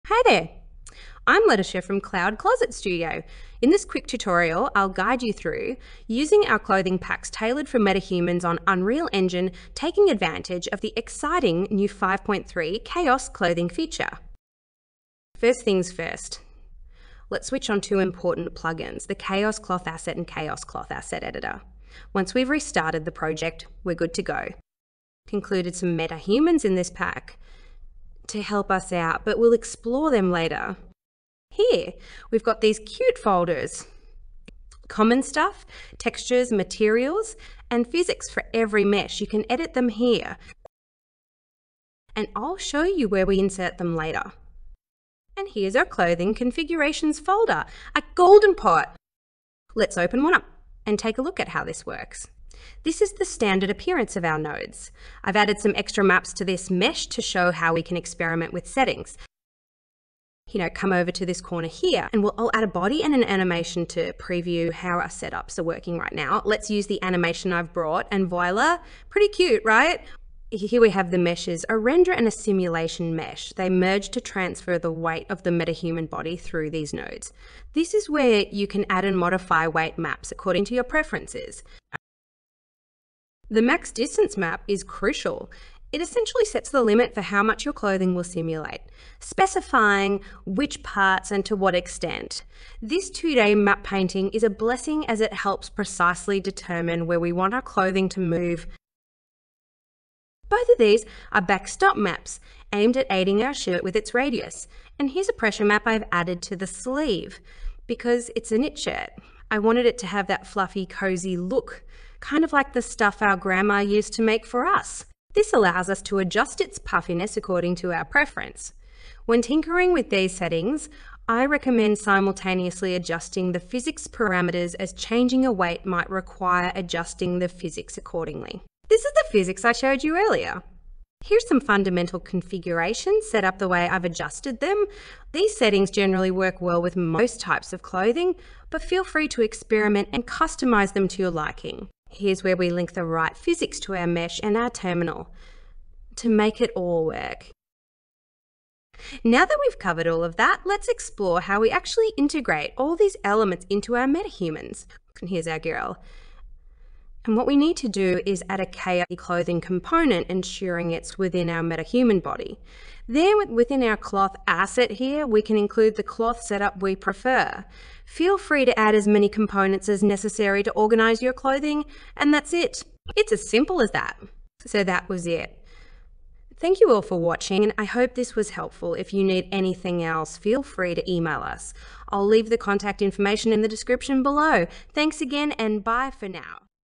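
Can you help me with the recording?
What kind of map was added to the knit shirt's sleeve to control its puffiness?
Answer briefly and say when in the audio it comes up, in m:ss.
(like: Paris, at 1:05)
pressure map, at 1:45.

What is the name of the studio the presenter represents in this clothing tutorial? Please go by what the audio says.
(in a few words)
Cloud Closet Studio.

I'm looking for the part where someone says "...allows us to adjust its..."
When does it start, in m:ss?
1:55.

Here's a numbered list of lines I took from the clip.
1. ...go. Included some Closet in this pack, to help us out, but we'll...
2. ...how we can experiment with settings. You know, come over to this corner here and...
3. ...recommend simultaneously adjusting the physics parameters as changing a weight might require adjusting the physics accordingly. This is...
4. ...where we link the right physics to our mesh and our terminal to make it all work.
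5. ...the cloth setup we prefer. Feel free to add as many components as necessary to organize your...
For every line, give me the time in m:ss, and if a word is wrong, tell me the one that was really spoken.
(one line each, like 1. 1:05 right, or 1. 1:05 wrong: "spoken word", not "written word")
1. 0:24 wrong: "MetaHumans", not "Closet"
2. 0:57 right
3. 2:01 right
4. 2:22 right
5. 2:45 right.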